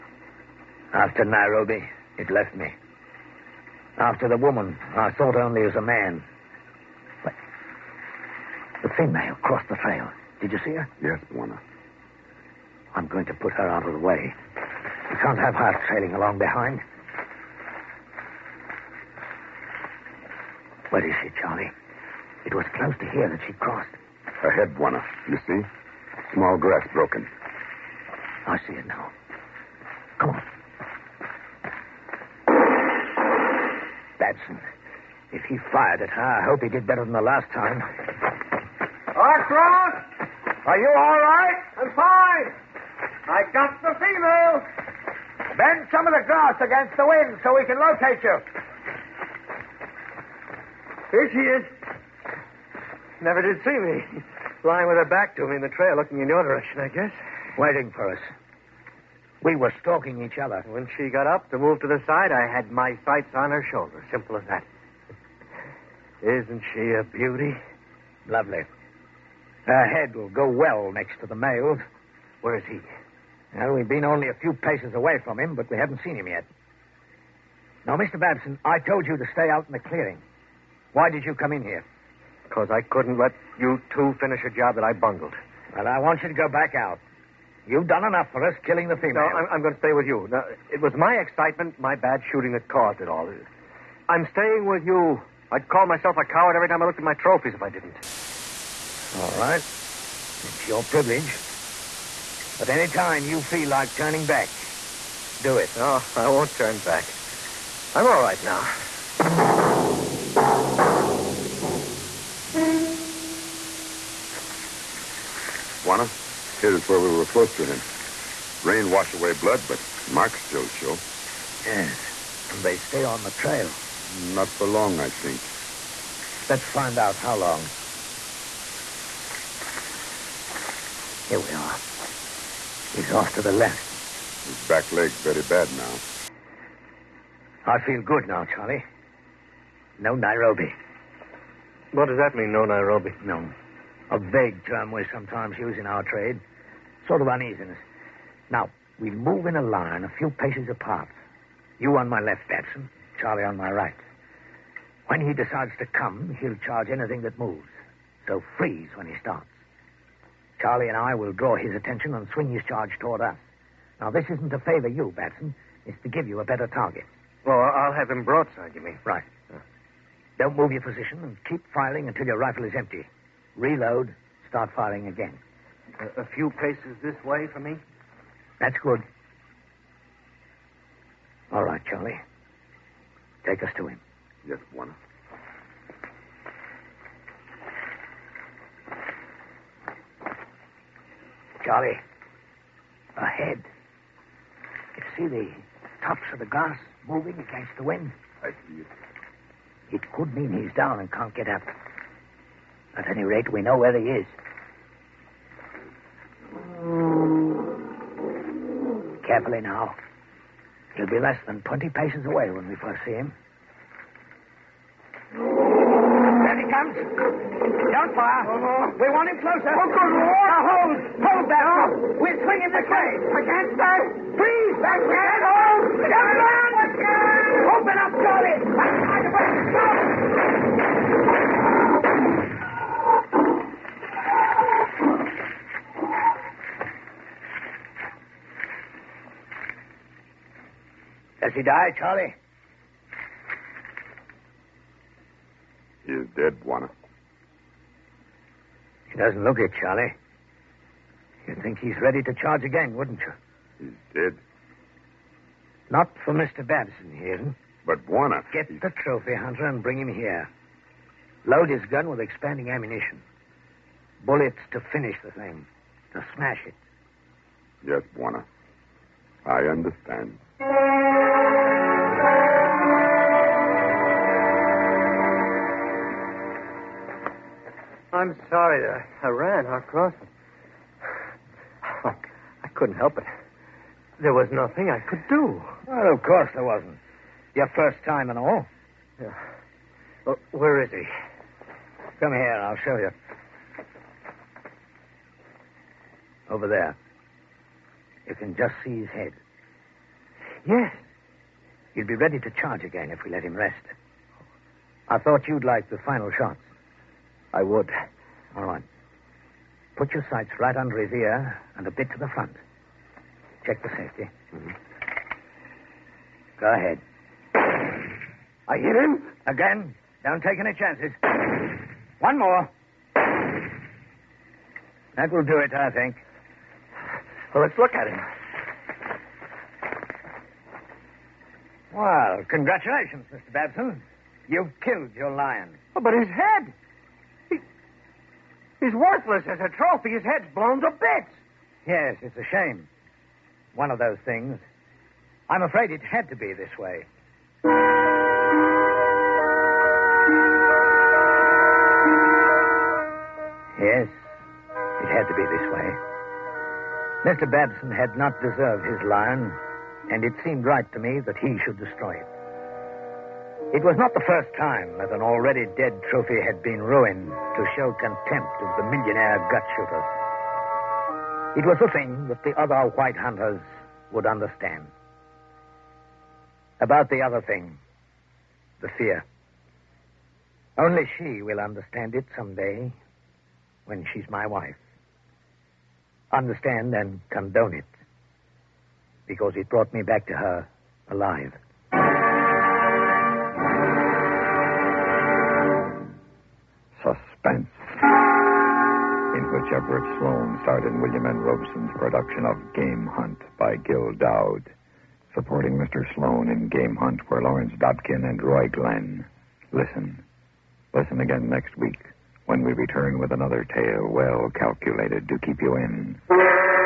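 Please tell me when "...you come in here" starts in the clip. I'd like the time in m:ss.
1:21.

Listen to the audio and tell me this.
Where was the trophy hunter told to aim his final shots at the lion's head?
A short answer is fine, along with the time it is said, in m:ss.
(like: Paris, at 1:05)
Right under his ear, at 5:10.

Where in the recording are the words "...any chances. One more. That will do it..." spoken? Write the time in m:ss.
5:20.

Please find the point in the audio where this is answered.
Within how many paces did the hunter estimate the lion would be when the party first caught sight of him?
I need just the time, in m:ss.
3:31.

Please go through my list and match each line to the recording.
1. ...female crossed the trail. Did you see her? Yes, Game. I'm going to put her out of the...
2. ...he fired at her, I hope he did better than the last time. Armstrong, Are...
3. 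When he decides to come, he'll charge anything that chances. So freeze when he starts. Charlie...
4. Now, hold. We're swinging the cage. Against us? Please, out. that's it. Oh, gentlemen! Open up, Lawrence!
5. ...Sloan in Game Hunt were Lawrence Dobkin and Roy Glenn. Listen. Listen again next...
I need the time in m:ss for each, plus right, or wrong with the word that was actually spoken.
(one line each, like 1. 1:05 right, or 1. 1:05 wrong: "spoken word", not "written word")
1. 0:08 wrong: "Warner", not "Game"
2. 0:35 right
3. 2:35 wrong: "moves", not "chances"
4. 3:40 wrong: "Charlie", not "Lawrence"
5. 6:46 right.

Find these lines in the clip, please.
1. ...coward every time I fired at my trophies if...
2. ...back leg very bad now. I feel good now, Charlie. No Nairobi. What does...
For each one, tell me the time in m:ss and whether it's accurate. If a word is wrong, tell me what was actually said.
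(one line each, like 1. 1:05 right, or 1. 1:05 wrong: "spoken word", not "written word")
1. 1:36 wrong: "looked", not "fired"
2. 2:14 right.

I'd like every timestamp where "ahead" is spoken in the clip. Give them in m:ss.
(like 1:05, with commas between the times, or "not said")
0:24, 5:16.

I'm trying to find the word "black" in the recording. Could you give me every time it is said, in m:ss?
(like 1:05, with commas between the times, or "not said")
not said.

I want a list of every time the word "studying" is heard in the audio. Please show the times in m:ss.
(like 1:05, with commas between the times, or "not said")
not said.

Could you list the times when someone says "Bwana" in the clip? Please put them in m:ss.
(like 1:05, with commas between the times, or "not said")
4:18, 4:28.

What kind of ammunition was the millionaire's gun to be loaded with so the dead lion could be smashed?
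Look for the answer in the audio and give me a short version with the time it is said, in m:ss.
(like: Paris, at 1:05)
Expanding ammunition, at 4:22.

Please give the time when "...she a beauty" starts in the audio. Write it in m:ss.
1:06.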